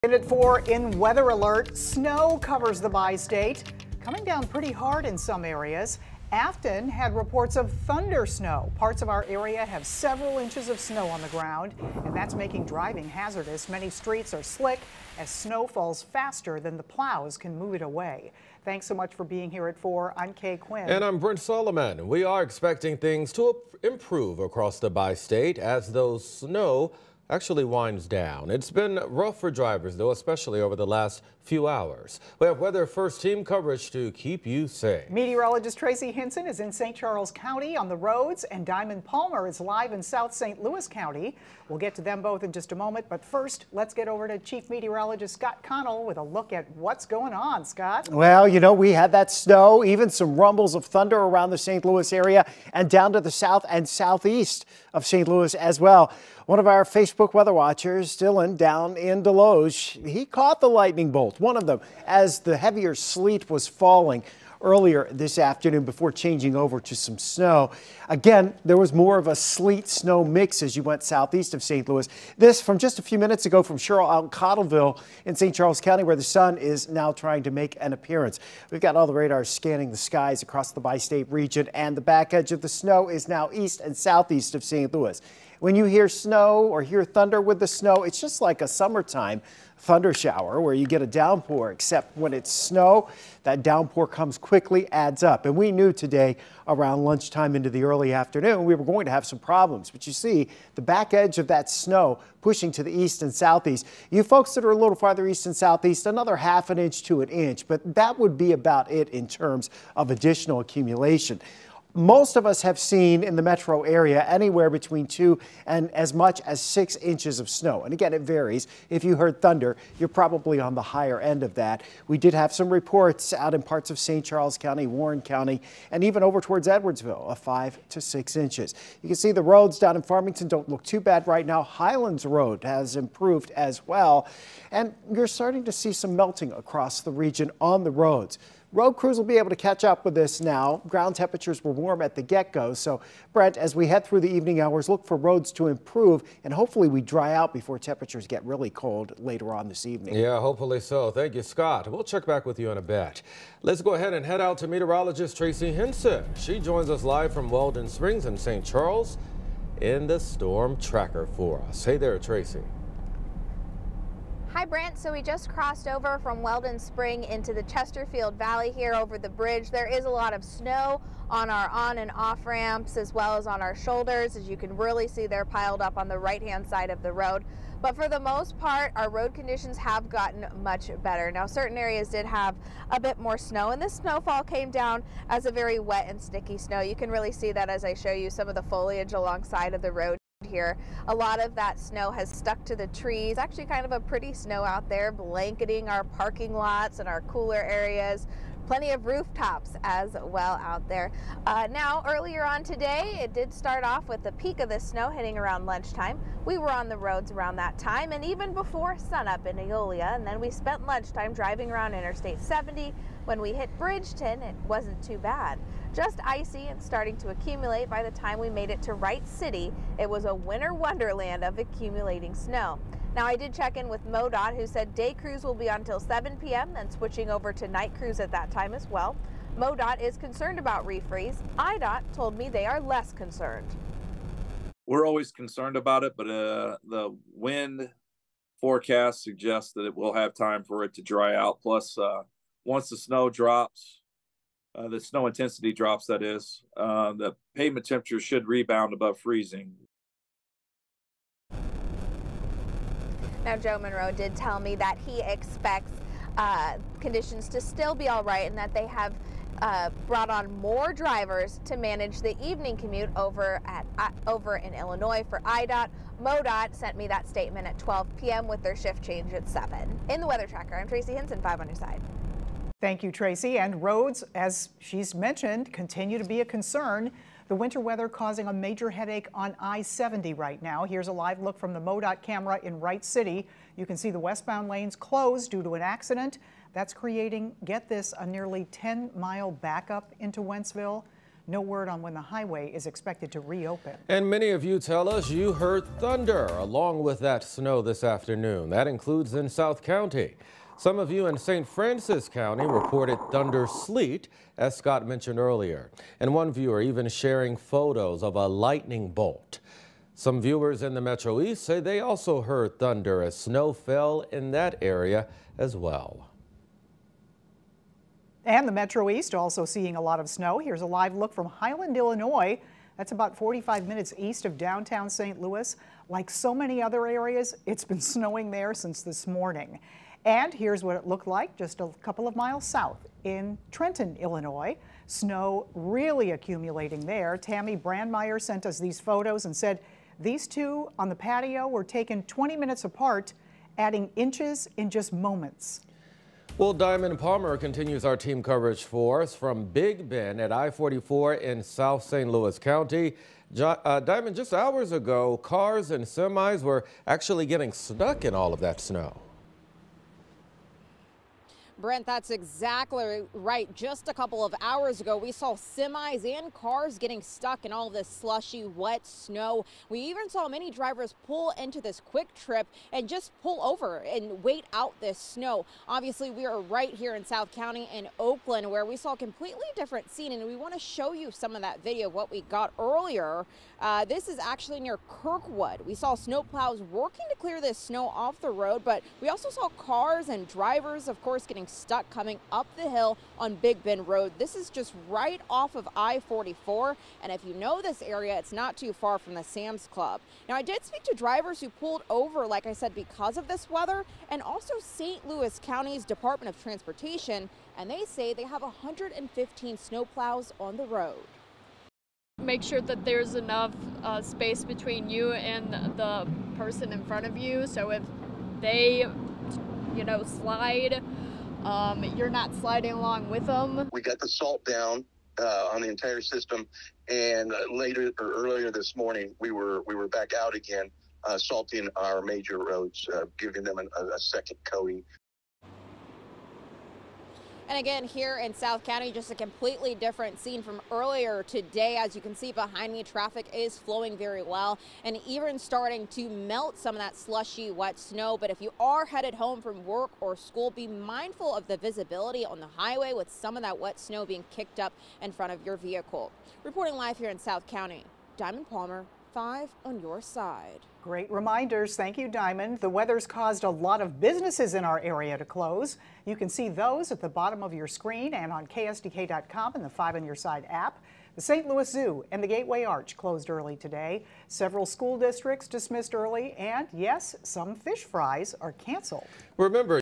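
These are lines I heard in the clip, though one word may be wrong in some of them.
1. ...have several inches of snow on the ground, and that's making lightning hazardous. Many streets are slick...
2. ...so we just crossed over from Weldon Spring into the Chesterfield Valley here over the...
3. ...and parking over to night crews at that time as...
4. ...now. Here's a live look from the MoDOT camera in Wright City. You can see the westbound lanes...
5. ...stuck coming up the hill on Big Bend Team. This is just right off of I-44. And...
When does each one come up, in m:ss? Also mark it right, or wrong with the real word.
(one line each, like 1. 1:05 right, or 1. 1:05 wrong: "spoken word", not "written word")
1. 0:09 wrong: "driving", not "lightning"
2. 2:44 right
3. 3:46 wrong: "switching", not "parking"
4. 4:40 right
5. 6:31 wrong: "Road", not "Team".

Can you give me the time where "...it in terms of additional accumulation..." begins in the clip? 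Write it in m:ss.
1:48.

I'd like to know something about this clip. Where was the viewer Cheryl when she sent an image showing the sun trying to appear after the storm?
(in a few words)
Cottleville.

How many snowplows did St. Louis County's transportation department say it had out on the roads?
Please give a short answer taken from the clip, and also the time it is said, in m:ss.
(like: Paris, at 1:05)
115, at 6:48.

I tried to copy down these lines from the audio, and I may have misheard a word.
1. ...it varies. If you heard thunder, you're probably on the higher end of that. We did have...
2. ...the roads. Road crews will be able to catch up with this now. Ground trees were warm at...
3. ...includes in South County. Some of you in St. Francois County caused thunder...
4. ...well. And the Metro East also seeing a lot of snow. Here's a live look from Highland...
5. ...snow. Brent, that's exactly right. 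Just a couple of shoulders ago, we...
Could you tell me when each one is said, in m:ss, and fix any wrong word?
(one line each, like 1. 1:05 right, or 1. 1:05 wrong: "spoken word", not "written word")
1. 1:58 right
2. 2:17 wrong: "temperatures", not "trees"
3. 4:58 wrong: "reported", not "caused"
4. 5:15 right
5. 5:58 wrong: "hours", not "shoulders".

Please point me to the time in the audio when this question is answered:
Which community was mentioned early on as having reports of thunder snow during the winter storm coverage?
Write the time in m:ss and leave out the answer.
0:06.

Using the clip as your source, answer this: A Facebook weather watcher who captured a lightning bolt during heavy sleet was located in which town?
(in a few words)
Desloge.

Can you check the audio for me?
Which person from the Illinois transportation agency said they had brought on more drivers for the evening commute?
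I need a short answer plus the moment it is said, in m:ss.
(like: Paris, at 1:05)
Joe Monroe, at 4:13.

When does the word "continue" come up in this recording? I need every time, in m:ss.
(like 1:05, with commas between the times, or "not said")
4:35, 5:47.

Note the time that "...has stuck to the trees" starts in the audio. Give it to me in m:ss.
3:12.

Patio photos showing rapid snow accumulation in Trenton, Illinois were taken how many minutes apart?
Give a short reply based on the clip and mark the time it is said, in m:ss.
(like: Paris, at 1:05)
20, at 5:42.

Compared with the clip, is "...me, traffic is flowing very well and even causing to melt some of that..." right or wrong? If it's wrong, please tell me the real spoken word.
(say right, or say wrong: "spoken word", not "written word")
wrong: "starting", not "causing".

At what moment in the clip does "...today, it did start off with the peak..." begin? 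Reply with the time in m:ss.
3:22.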